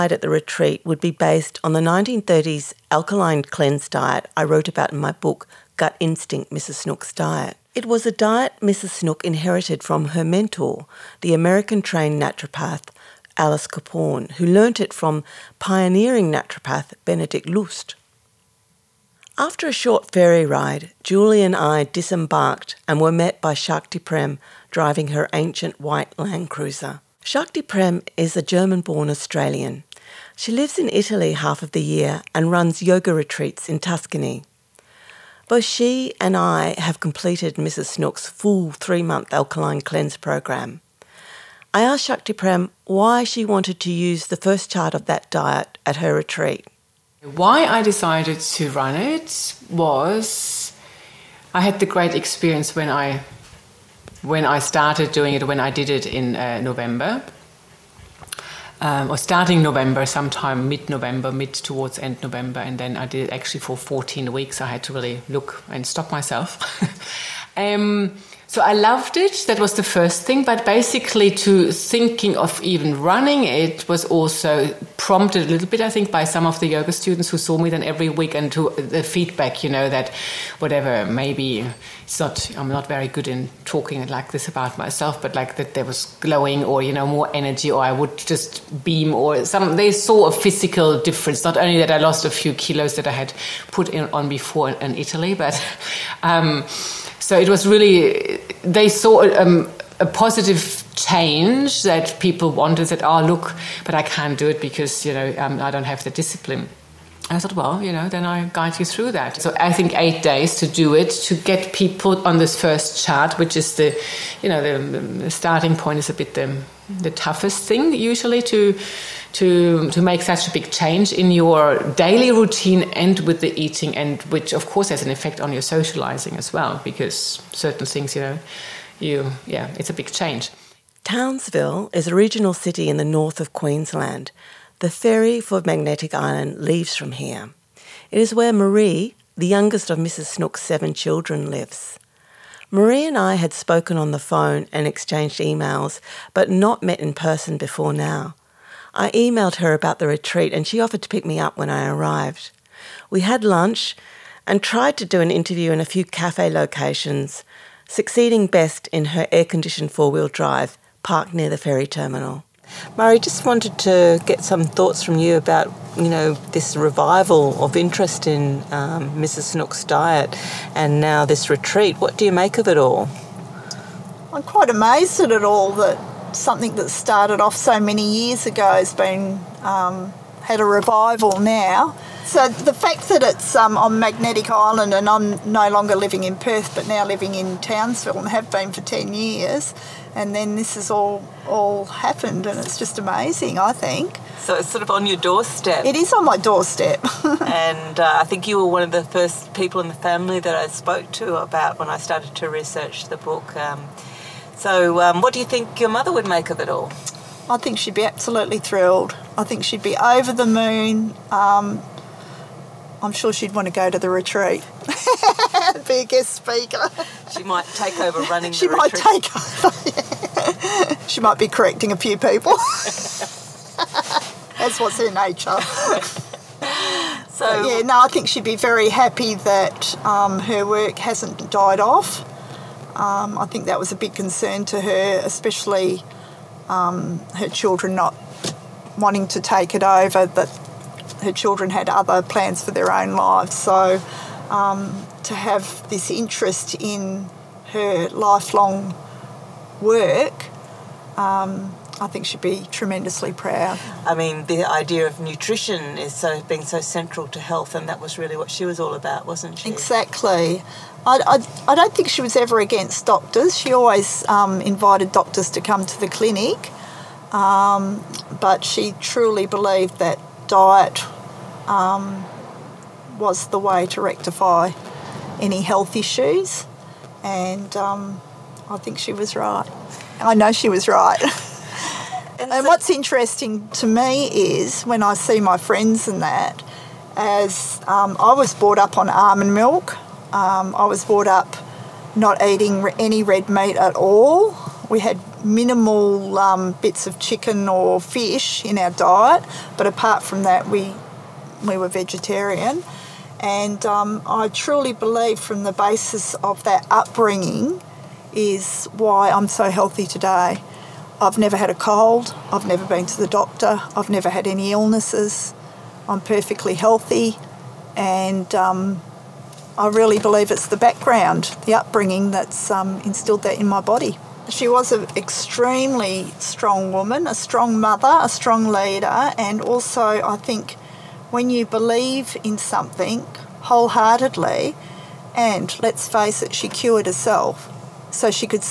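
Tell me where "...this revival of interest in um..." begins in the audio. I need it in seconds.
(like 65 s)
166 s.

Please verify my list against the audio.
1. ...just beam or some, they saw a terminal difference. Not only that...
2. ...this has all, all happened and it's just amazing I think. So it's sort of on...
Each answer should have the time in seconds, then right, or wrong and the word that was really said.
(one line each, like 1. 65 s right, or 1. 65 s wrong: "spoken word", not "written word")
1. 88 s wrong: "physical", not "terminal"
2. 190 s right.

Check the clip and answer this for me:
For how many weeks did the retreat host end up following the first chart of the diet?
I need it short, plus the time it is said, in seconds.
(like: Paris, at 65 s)
14, at 63 s.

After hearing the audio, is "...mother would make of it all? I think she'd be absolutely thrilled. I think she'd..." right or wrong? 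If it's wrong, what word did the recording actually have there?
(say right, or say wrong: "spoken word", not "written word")
right.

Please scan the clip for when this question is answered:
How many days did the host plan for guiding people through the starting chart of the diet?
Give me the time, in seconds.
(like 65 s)
109 s.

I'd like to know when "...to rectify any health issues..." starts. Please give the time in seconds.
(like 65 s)
273 s.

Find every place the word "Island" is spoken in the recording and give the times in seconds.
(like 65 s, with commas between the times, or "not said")
136 s, 184 s.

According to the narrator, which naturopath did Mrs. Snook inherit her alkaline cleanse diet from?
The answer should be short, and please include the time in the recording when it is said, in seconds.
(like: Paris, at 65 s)
Alice Caporn, at 13 s.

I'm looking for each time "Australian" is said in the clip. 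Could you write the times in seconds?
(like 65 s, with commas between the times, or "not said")
29 s.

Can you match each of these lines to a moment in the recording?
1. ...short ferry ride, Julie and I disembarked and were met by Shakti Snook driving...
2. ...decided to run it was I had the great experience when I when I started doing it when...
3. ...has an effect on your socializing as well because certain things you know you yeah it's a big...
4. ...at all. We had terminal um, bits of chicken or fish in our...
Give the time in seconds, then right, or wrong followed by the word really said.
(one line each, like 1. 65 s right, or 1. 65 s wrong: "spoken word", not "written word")
1. 19 s wrong: "Prem", not "Snook"
2. 47 s right
3. 124 s right
4. 293 s wrong: "minimal", not "terminal".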